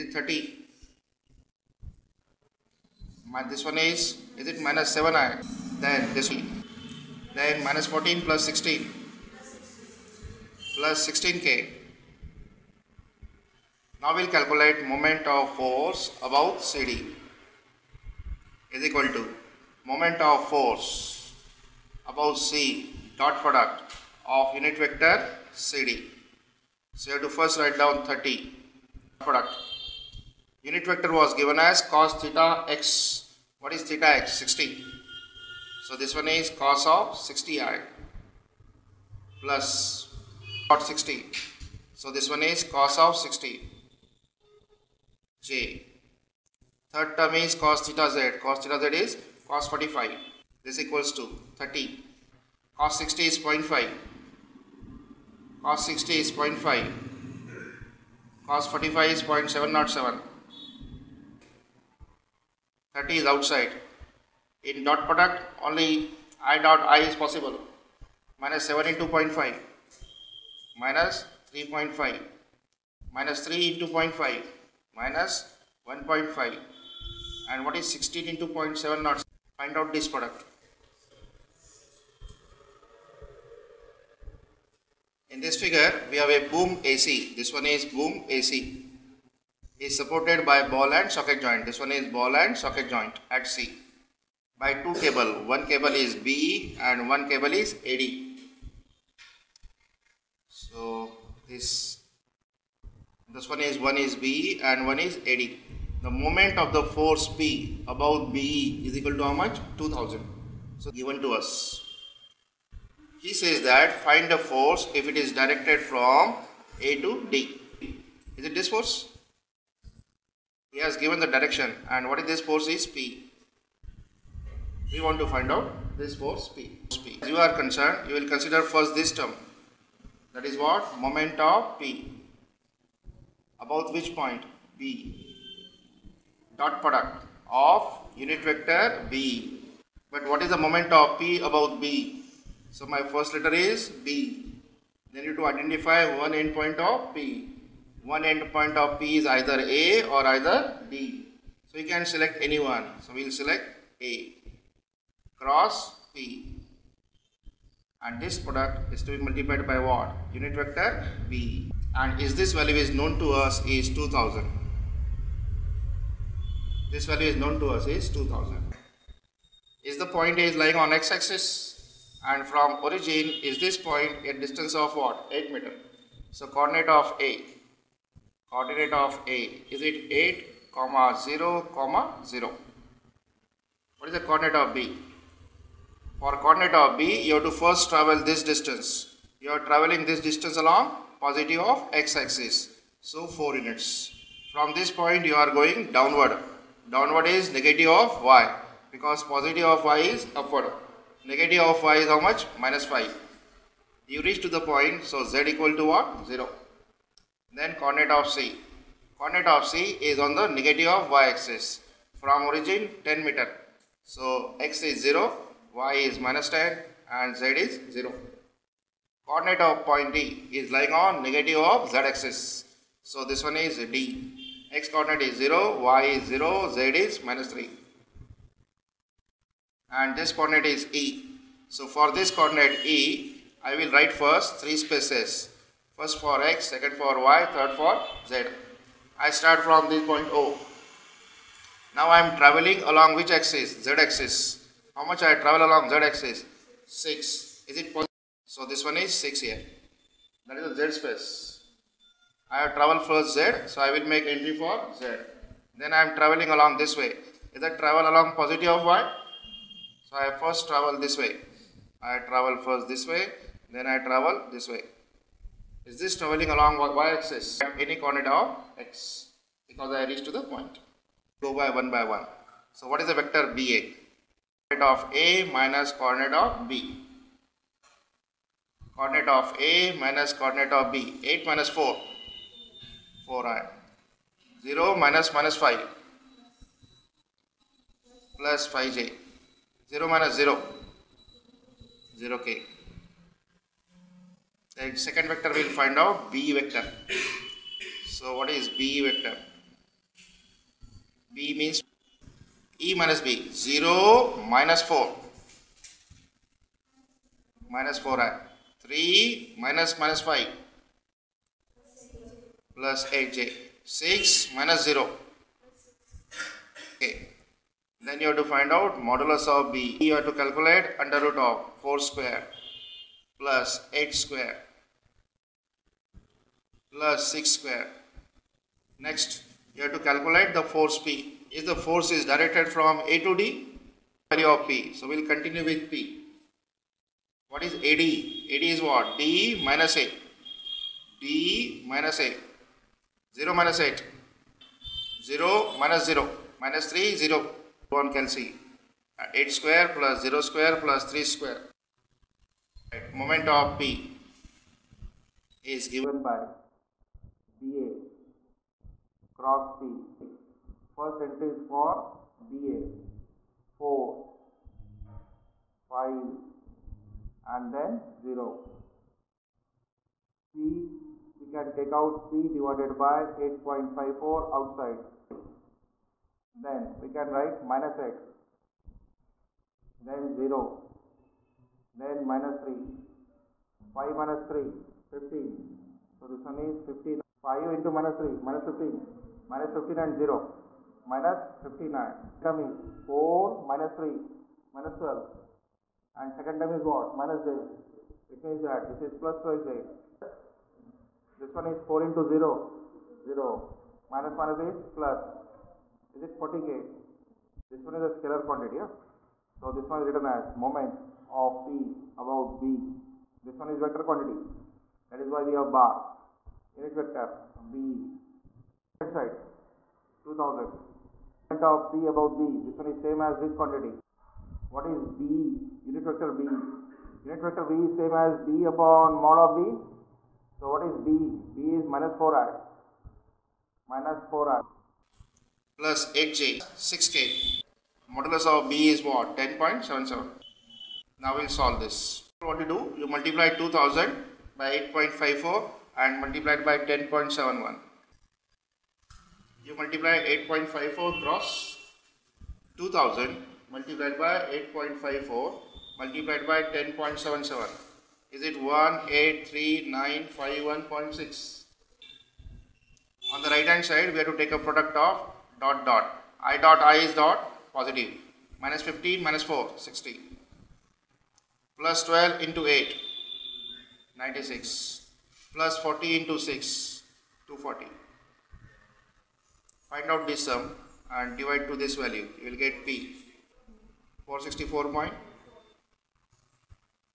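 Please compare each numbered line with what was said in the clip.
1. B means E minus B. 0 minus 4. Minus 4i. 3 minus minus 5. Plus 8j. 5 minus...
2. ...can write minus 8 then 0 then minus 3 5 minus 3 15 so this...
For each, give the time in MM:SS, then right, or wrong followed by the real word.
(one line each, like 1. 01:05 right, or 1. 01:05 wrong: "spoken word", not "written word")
1. 05:01 wrong: "6", not "5"
2. 06:17 right.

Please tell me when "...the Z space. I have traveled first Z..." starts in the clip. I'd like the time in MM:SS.
04:10.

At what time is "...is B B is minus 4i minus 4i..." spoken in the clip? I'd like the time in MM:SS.
07:10.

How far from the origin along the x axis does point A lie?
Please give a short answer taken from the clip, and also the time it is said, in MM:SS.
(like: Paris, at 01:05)
8 meter, at 02:55.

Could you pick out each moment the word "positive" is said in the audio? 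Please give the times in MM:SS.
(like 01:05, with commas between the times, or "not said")
03:11, 03:19, 04:18, 07:47.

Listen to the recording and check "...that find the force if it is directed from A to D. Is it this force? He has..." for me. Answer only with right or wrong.
right.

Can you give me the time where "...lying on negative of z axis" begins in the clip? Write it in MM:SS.
03:40.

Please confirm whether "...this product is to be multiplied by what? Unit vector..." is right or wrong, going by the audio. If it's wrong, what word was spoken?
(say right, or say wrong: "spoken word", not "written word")
right.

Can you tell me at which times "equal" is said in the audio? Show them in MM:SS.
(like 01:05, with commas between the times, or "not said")
00:18, 00:50, 01:48, 03:25.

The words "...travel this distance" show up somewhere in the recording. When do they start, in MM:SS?
03:07.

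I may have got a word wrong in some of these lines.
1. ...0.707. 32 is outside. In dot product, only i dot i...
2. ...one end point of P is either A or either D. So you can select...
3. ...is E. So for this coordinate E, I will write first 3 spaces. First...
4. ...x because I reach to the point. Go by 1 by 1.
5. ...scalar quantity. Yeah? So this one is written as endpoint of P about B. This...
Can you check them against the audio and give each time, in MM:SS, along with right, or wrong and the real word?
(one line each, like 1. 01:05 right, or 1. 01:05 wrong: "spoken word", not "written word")
1. 00:59 wrong: "30", not "32"
2. 02:28 right
3. 03:50 right
4. 04:28 right
5. 06:48 wrong: "moment", not "endpoint".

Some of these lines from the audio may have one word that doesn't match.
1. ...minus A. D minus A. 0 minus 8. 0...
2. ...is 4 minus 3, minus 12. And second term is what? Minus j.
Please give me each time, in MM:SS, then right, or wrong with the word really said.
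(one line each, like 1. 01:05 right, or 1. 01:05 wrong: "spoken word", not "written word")
1. 05:39 right
2. 06:32 right.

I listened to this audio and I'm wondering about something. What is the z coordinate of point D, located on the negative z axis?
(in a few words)
-3.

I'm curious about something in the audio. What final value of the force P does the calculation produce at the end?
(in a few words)
464.5.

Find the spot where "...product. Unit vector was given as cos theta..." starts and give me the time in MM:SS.
00:29.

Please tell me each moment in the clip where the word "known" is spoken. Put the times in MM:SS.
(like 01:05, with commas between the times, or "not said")
02:42, 02:47.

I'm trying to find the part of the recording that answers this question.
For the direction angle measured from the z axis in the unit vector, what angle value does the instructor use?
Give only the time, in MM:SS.
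00:48.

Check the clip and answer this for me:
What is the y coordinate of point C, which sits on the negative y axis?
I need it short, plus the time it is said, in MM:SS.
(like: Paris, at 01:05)
-10, at 03:36.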